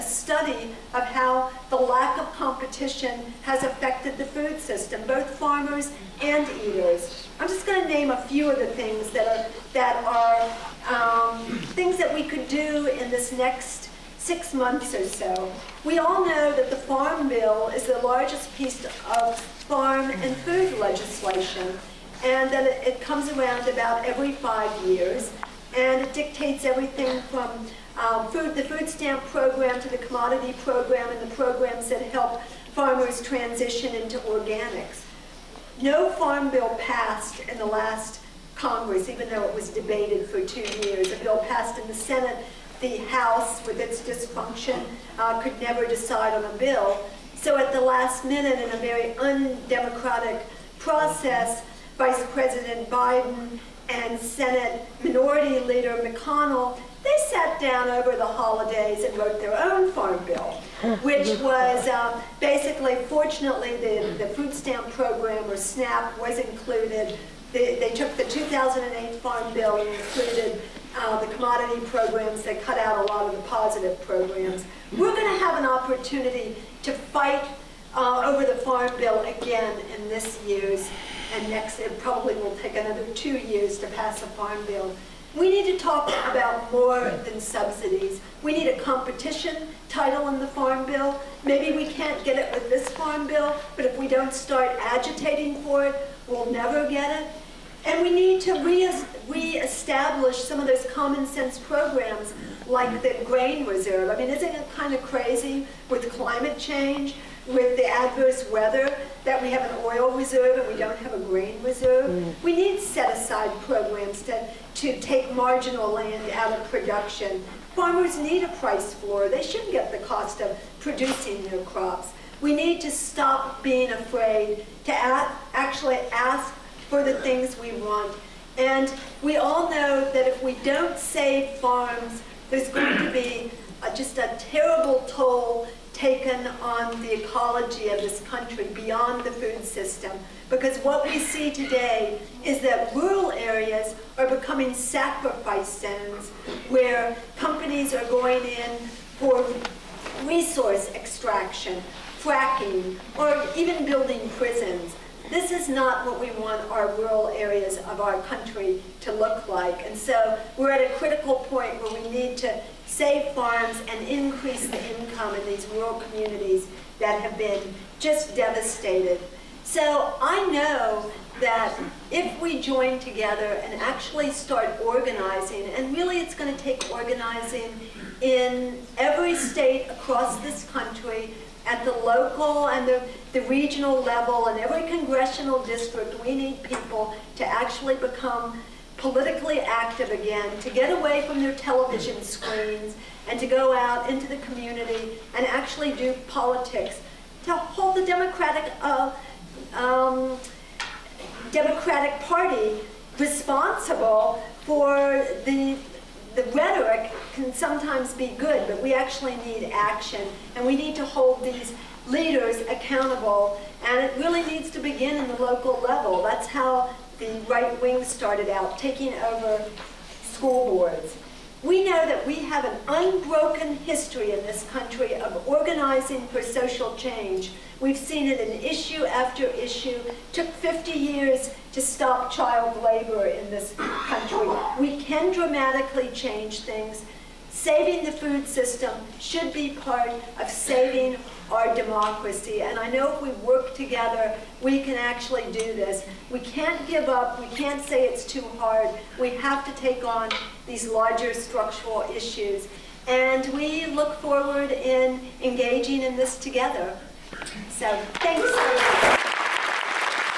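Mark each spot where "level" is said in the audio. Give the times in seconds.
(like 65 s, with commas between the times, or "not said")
184 s, 215 s.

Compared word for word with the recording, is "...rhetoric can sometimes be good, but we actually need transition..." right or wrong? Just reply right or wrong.
wrong.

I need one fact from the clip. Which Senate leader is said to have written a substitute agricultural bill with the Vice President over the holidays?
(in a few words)
McConnell.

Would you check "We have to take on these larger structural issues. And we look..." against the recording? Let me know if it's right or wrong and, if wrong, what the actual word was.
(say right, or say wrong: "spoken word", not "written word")
right.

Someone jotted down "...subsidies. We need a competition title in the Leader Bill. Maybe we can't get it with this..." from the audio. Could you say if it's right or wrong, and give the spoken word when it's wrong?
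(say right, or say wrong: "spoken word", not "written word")
wrong: "Farm", not "Leader".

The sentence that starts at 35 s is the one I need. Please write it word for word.
No farm bill passed in the last Congress, even though it was debated for two years.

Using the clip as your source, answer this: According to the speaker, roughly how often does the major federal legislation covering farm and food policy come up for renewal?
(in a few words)
every 5 years.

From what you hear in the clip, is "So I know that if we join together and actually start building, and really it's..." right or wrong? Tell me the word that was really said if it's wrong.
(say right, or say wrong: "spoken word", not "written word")
wrong: "organizing", not "building".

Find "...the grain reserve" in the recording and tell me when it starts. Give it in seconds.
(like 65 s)
103 s.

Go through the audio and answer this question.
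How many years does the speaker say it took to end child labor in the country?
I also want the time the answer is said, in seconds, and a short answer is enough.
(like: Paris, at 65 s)
50, at 230 s.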